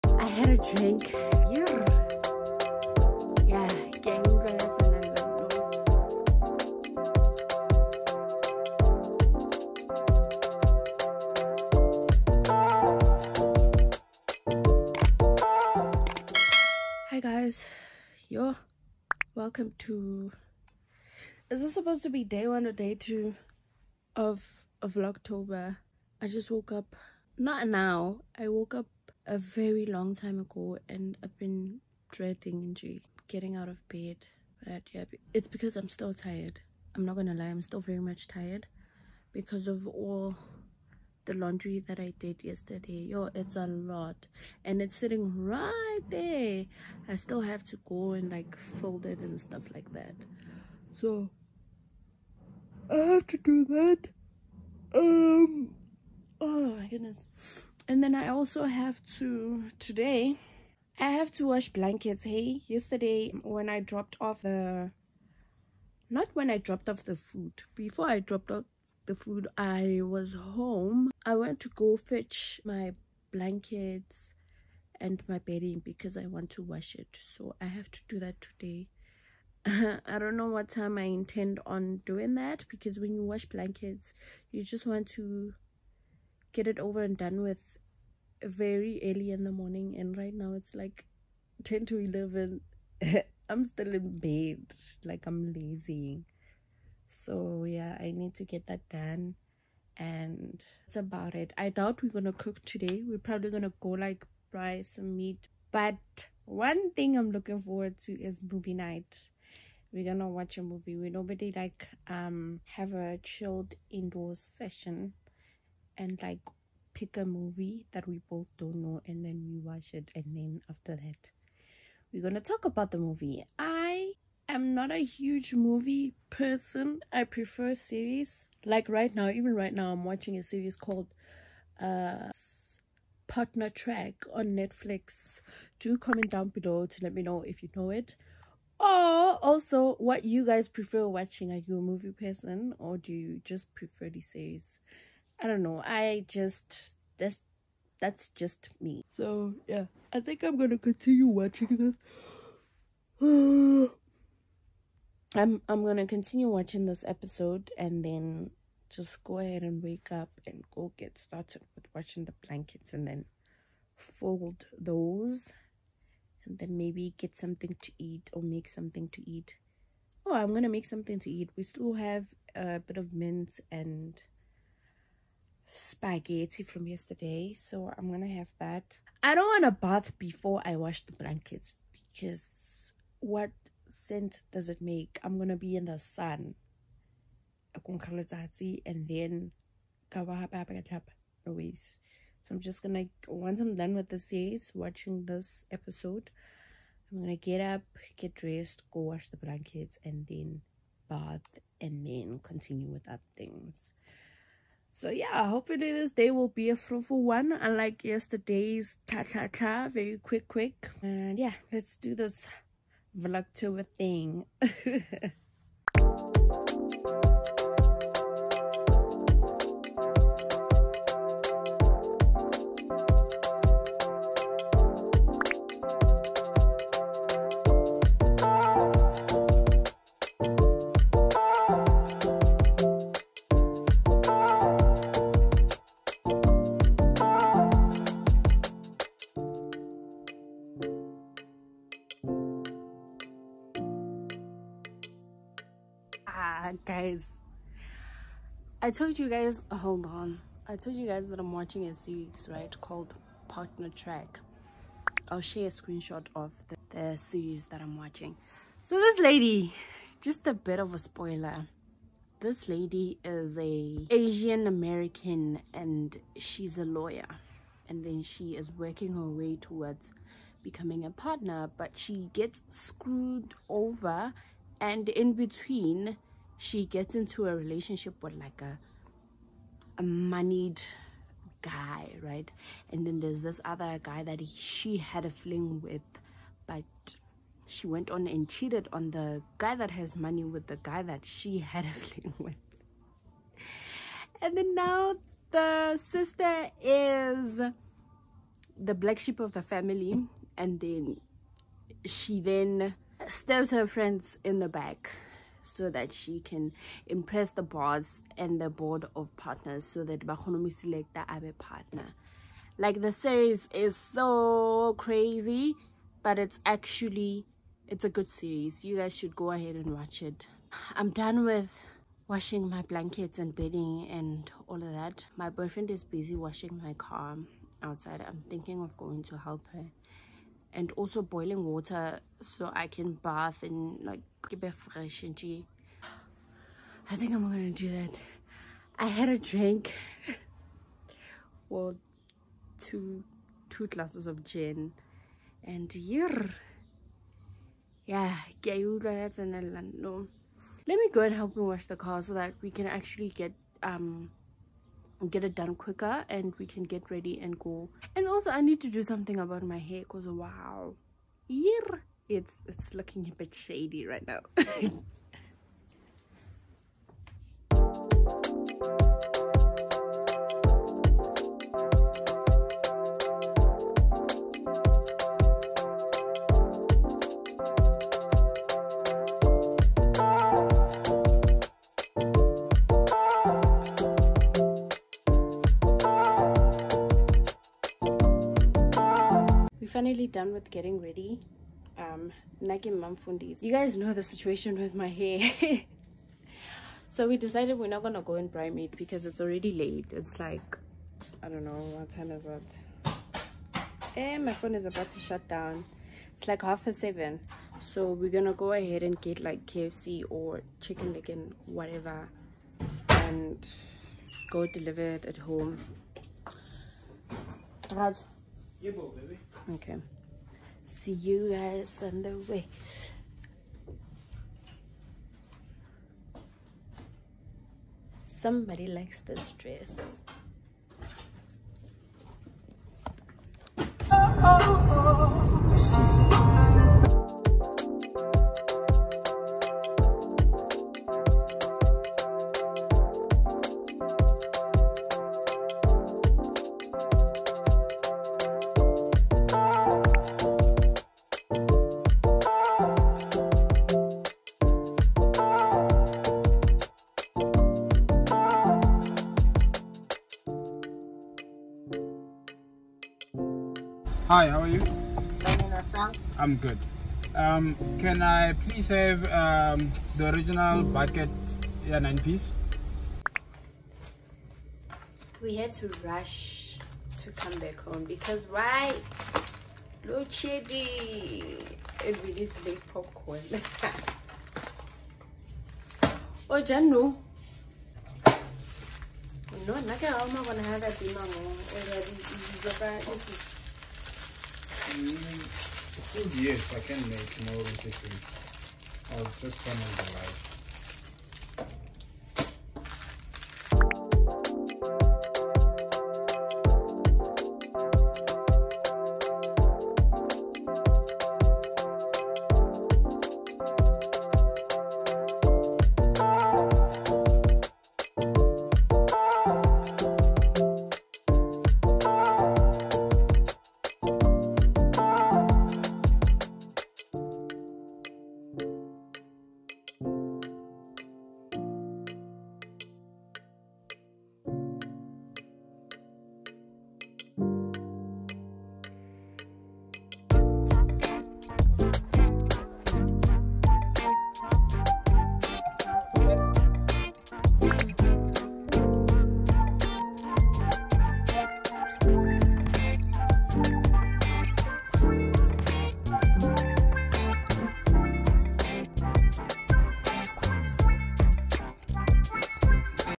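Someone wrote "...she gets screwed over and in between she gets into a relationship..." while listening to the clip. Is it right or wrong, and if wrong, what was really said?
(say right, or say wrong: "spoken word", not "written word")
right.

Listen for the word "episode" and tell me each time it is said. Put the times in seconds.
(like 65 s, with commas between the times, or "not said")
157 s, 195 s.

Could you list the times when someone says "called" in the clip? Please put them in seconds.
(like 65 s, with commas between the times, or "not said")
130 s, 252 s.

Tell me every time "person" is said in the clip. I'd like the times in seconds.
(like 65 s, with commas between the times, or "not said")
126 s, 142 s.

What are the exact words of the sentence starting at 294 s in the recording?
And then now the sister is the black sheep of the family.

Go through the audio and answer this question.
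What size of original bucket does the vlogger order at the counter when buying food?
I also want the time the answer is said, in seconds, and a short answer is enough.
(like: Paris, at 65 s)
9 piece, at 471 s.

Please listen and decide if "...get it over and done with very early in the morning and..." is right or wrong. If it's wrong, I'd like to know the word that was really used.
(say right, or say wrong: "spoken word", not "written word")
right.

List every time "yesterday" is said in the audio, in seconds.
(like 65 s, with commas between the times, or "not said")
42 s, 62 s, 176 s, 208 s.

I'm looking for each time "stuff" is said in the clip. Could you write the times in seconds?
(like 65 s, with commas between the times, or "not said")
49 s.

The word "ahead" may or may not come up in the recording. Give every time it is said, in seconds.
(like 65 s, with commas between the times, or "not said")
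159 s, 319 s, 408 s.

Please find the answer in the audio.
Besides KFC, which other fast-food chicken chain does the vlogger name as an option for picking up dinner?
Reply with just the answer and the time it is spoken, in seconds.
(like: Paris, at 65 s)
Chicken Licken, at 410 s.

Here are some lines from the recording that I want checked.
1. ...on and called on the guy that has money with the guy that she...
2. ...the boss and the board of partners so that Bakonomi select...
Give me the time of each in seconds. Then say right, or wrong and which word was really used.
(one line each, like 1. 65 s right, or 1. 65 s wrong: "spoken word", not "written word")
1. 288 s wrong: "cheated", not "called"
2. 307 s right.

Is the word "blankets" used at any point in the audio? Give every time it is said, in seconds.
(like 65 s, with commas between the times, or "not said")
61 s, 73 s, 83 s, 162 s, 181 s, 199 s, 322 s.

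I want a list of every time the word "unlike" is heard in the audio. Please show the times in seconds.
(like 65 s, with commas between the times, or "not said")
207 s.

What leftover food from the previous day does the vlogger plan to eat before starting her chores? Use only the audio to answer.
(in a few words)
Spaghetti.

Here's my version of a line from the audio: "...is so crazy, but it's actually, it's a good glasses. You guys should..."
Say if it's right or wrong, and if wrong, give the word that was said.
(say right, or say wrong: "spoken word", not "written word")
wrong: "series", not "glasses".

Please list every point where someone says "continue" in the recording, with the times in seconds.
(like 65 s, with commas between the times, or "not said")
150 s, 156 s, 202 s.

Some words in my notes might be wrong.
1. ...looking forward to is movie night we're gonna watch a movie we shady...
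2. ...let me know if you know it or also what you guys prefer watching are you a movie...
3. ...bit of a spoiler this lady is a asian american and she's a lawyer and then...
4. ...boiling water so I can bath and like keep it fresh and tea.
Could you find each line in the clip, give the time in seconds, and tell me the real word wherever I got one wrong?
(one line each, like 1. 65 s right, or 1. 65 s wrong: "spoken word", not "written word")
1. 107 s wrong: "nobody", not "shady"
2. 137 s right
3. 260 s right
4. 331 s right.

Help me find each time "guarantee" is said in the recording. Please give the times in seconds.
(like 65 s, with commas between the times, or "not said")
not said.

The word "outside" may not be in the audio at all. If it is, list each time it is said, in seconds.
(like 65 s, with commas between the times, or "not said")
327 s.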